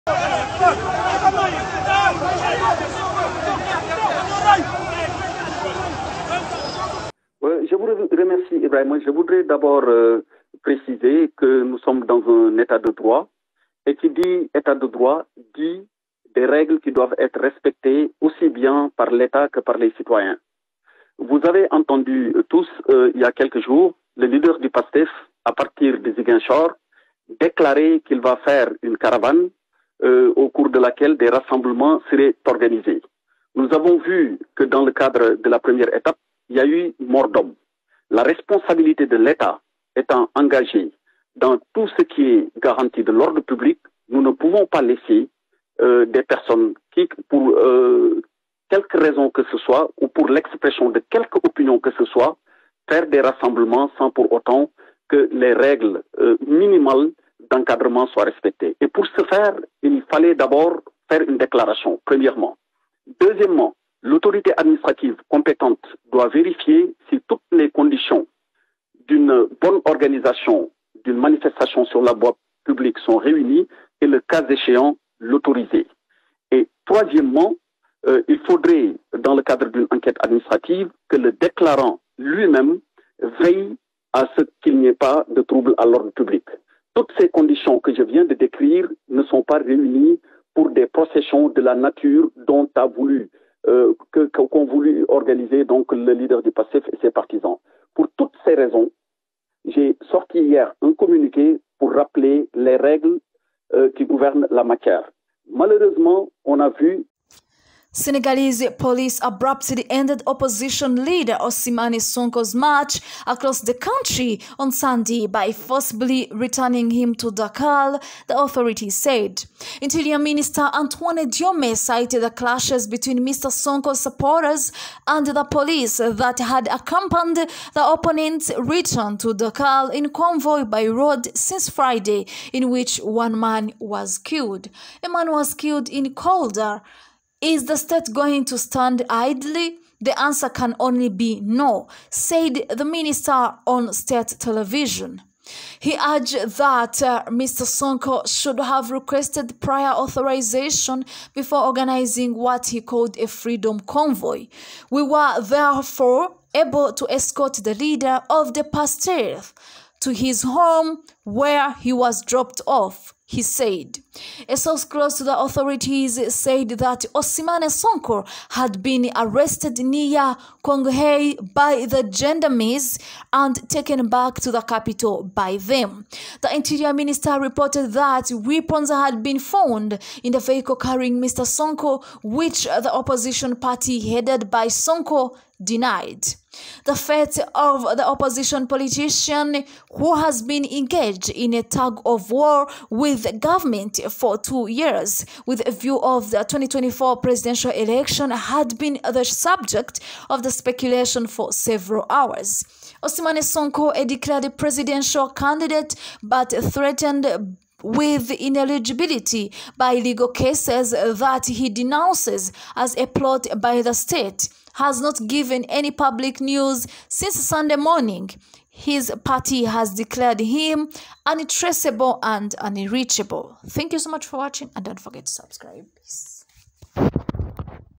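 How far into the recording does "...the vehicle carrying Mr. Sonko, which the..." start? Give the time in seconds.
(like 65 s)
180 s.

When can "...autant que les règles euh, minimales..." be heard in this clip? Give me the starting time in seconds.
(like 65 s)
54 s.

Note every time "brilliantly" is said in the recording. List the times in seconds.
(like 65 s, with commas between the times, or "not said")
not said.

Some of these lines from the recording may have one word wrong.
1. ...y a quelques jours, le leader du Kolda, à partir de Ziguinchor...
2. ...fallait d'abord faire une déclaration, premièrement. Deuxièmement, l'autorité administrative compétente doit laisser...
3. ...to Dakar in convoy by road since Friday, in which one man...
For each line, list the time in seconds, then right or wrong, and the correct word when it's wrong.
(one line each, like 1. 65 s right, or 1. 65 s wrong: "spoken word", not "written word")
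1. 23 s wrong: "PASTEF", not "Kolda"
2. 60 s wrong: "vérifier", not "laisser"
3. 129 s right.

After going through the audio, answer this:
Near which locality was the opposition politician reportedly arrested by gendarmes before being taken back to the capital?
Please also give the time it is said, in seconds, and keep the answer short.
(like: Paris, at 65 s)
Koungheul, at 170 s.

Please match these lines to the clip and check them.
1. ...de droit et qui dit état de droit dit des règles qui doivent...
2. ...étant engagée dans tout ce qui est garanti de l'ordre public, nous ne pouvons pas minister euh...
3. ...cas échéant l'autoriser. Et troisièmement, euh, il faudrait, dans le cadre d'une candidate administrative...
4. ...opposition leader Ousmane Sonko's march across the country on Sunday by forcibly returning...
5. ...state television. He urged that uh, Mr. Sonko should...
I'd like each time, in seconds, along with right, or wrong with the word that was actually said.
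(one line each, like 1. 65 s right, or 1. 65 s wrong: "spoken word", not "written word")
1. 12 s right
2. 39 s wrong: "laisser", not "minister"
3. 74 s wrong: "enquête", not "candidate"
4. 110 s right
5. 143 s right.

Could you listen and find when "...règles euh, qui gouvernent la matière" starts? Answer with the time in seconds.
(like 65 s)
102 s.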